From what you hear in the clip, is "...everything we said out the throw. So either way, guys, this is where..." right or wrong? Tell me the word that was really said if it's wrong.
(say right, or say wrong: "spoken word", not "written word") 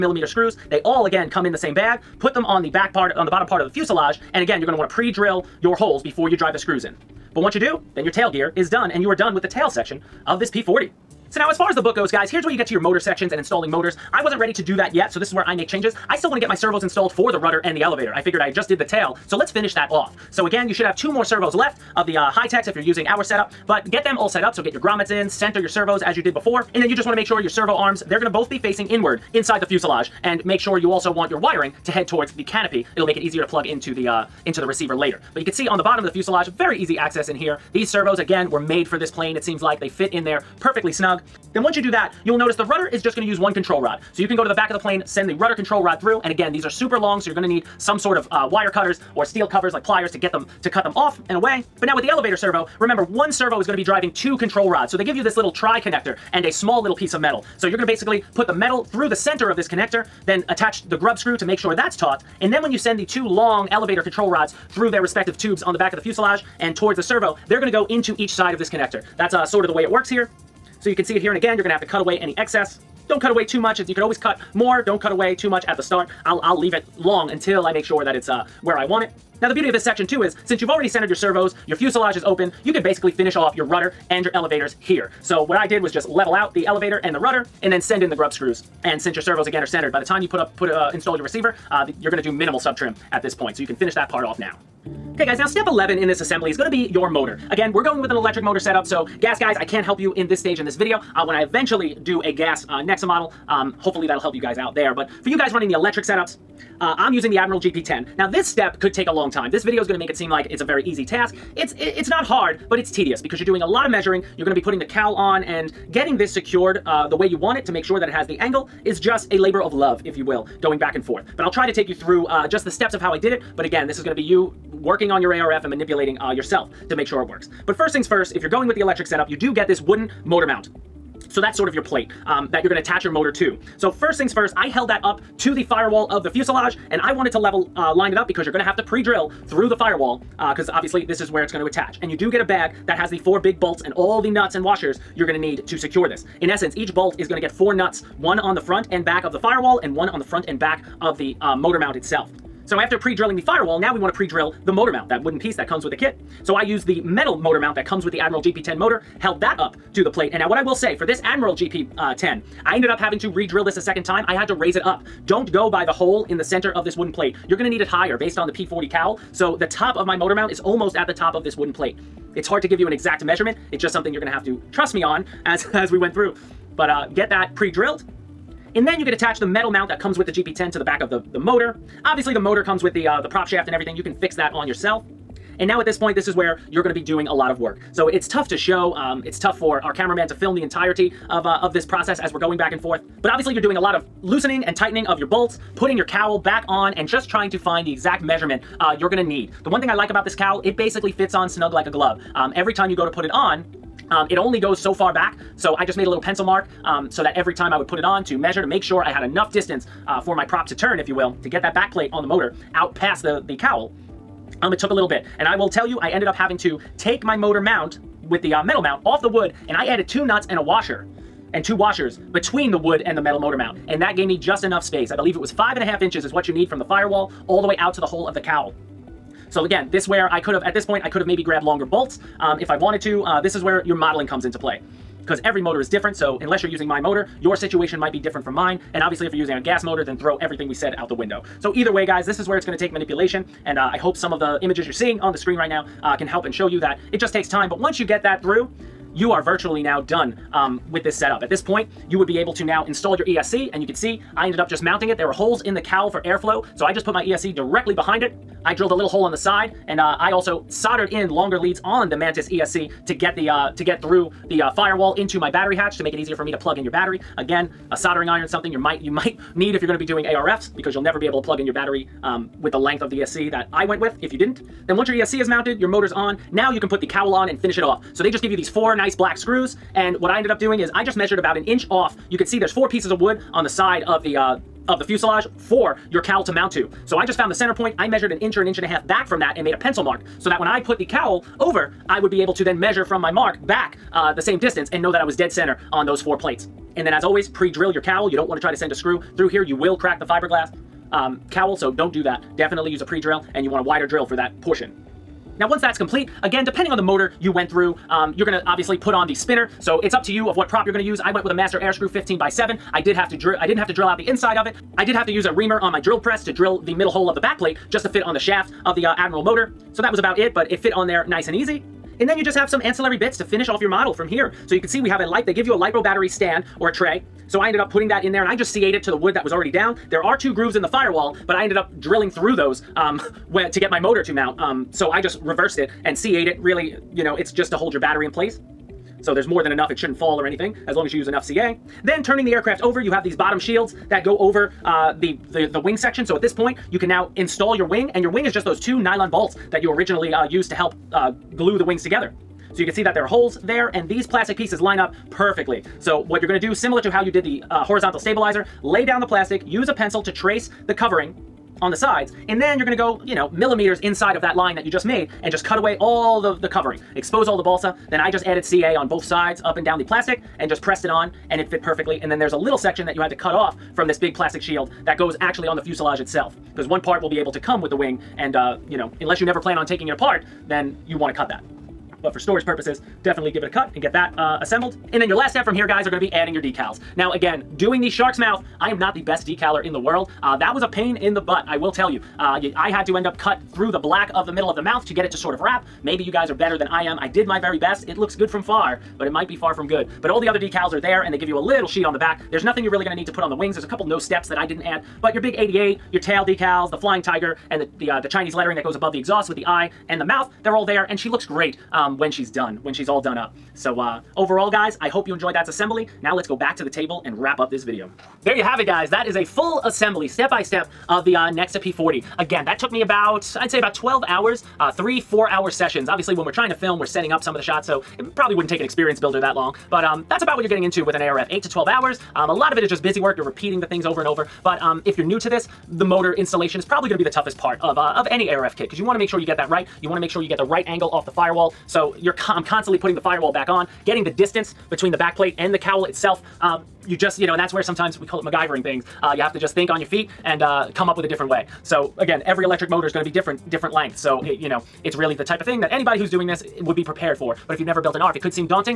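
wrong: "window", not "throw".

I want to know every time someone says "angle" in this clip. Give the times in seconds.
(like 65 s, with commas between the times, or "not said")
118 s, 440 s.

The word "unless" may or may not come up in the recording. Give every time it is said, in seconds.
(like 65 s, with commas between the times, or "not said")
236 s, 379 s.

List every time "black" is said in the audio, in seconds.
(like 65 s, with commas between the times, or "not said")
279 s, 393 s.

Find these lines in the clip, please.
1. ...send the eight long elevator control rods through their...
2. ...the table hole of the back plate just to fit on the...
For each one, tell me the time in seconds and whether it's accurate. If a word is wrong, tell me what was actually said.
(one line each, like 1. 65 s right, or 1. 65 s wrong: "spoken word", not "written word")
1. 62 s wrong: "two", not "eight"
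2. 316 s wrong: "middle", not "table".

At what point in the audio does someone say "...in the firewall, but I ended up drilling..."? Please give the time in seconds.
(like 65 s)
330 s.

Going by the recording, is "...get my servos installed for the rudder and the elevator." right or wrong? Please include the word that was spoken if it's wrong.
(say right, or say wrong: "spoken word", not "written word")
right.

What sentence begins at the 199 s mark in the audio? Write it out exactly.
The one thing I like about this cowl, it basically fits on snug like a glove.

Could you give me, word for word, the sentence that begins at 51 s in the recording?
But now with the elevator servo, remember one servo is going to be driving two control rods.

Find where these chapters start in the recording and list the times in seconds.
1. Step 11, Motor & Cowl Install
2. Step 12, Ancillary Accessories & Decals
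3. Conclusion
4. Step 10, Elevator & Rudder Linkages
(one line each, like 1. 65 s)
1. 94 s
2. 324 s
3. 418 s
4. 11 s.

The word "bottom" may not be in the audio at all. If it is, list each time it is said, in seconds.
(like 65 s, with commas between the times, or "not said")
3 s, 35 s, 343 s.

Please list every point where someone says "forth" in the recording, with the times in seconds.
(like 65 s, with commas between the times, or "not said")
121 s, 192 s.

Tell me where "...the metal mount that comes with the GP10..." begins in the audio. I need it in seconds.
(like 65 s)
179 s.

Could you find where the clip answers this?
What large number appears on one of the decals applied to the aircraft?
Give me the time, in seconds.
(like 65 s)
405 s.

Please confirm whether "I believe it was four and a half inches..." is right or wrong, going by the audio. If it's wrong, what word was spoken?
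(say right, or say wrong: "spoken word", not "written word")
wrong: "five", not "four".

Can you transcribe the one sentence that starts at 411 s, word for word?
And she looks great um, when she's done, when she's all done up.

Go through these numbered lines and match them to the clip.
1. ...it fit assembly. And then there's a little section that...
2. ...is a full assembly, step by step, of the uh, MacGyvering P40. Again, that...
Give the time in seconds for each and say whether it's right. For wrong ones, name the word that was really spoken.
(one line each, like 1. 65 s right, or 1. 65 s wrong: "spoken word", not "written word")
1. 371 s wrong: "perfectly", not "assembly"
2. 419 s wrong: "Nexa", not "MacGyvering".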